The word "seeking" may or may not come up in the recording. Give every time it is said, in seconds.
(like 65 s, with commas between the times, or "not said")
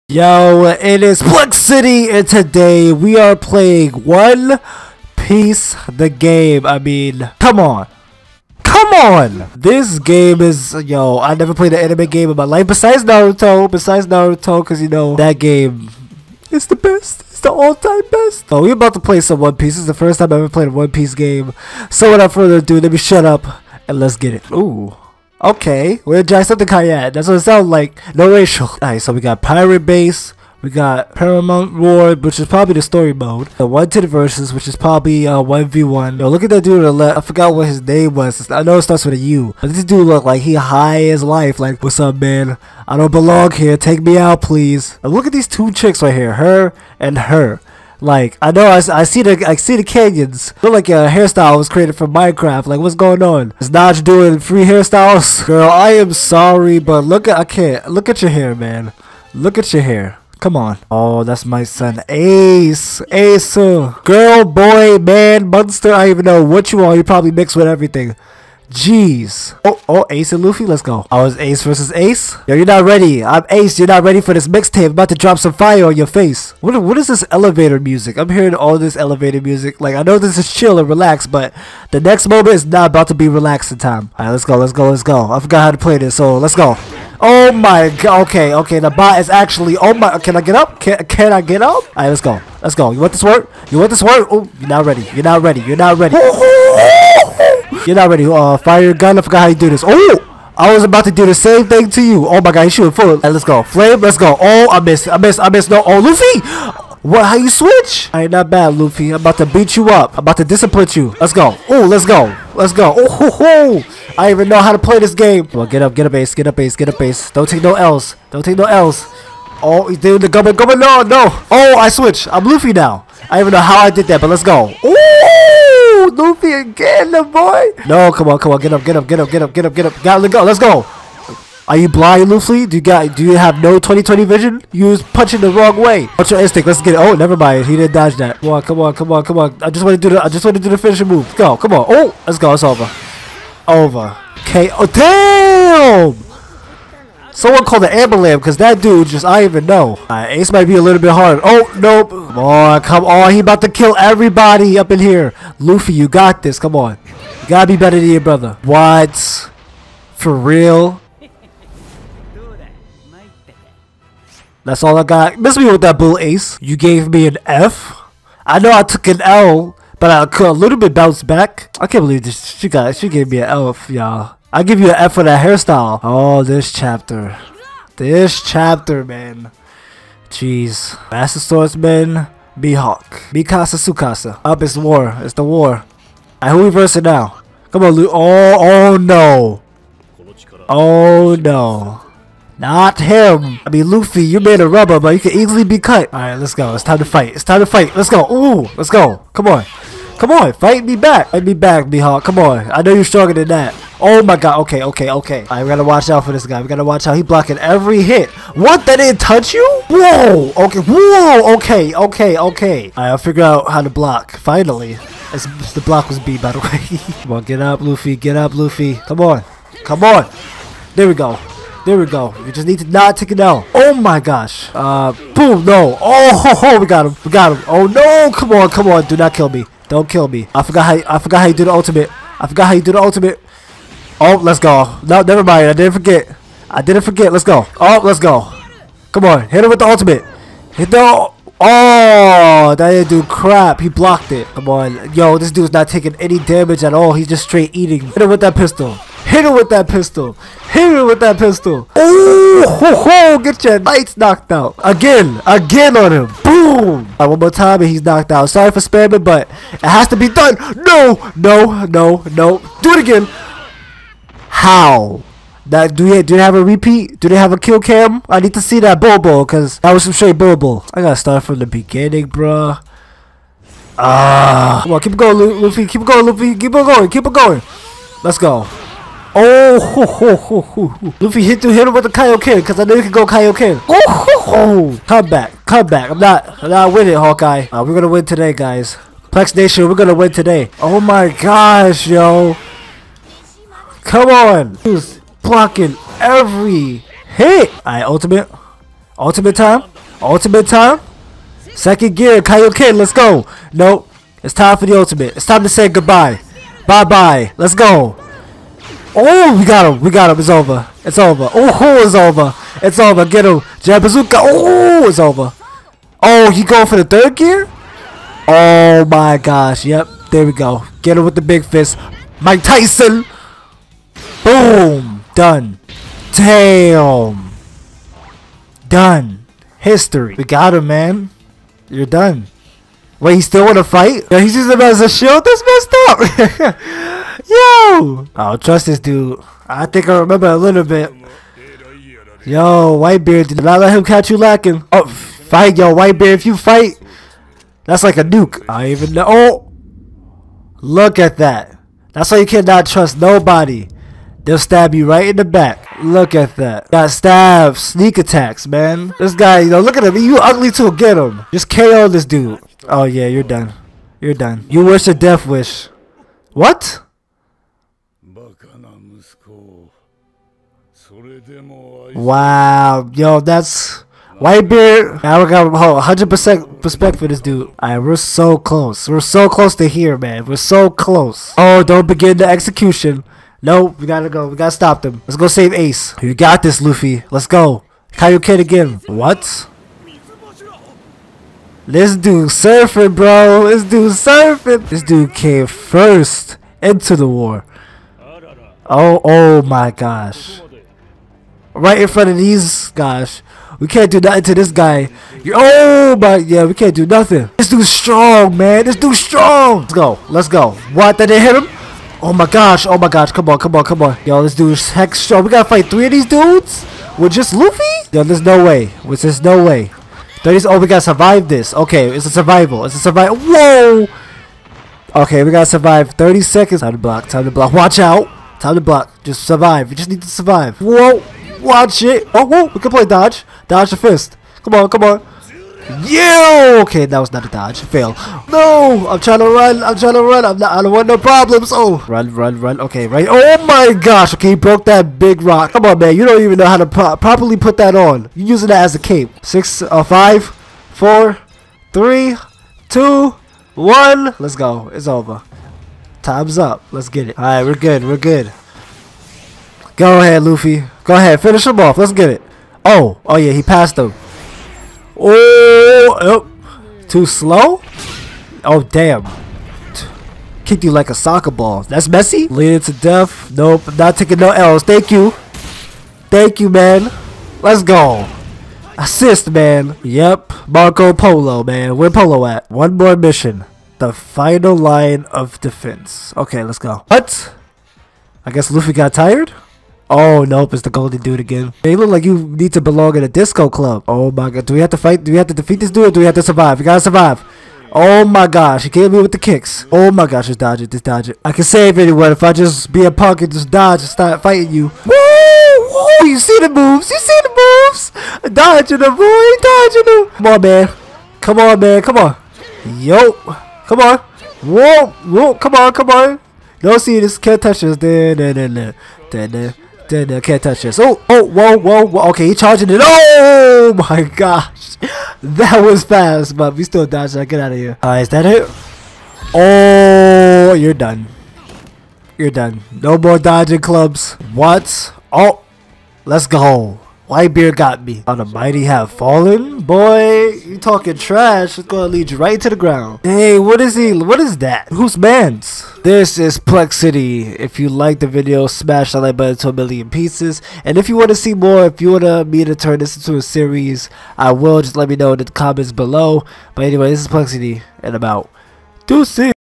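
not said.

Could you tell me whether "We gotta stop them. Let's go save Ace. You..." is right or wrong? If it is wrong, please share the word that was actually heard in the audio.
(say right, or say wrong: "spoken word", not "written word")
right.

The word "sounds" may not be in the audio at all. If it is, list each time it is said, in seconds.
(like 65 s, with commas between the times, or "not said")
27 s.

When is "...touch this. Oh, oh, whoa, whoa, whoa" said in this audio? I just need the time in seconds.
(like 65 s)
520 s.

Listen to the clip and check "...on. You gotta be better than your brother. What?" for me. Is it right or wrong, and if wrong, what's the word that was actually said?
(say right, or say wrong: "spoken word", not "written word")
right.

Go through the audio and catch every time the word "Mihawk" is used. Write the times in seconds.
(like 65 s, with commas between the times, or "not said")
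182 s, 201 s.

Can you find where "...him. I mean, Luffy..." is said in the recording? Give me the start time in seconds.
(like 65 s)
192 s.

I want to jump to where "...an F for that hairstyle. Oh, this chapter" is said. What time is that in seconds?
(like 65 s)
174 s.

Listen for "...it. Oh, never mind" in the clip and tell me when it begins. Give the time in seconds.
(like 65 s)
136 s.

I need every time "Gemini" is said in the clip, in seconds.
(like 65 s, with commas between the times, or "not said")
not said.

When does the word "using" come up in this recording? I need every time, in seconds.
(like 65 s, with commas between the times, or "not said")
334 s, 448 s.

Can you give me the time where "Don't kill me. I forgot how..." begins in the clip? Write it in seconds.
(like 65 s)
229 s.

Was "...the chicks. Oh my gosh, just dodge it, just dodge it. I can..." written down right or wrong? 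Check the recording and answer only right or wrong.
wrong.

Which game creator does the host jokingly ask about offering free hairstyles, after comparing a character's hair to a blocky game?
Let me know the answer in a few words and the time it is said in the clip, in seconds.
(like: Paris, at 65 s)
Notch, at 53 s.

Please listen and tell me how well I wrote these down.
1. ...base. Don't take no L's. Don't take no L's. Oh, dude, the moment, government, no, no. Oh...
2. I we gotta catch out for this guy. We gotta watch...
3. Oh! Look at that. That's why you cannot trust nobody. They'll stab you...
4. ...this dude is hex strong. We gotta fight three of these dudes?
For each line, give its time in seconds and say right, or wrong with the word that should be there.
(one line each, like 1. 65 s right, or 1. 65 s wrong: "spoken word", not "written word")
1. 116 s wrong: "government", not "moment"
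2. 205 s wrong: "watch", not "catch"
3. 349 s right
4. 414 s right.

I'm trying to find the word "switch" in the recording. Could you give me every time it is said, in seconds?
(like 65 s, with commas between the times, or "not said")
107 s, 121 s.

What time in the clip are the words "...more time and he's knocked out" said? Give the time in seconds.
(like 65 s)
257 s.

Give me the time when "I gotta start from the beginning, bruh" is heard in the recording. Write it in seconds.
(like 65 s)
270 s.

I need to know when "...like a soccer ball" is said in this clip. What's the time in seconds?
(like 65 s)
470 s.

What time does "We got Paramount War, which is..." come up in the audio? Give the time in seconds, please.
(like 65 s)
30 s.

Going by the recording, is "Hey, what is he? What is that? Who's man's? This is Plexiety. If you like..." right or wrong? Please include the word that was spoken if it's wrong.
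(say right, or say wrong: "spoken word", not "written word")
right.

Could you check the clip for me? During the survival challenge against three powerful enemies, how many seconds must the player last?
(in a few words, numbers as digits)
30.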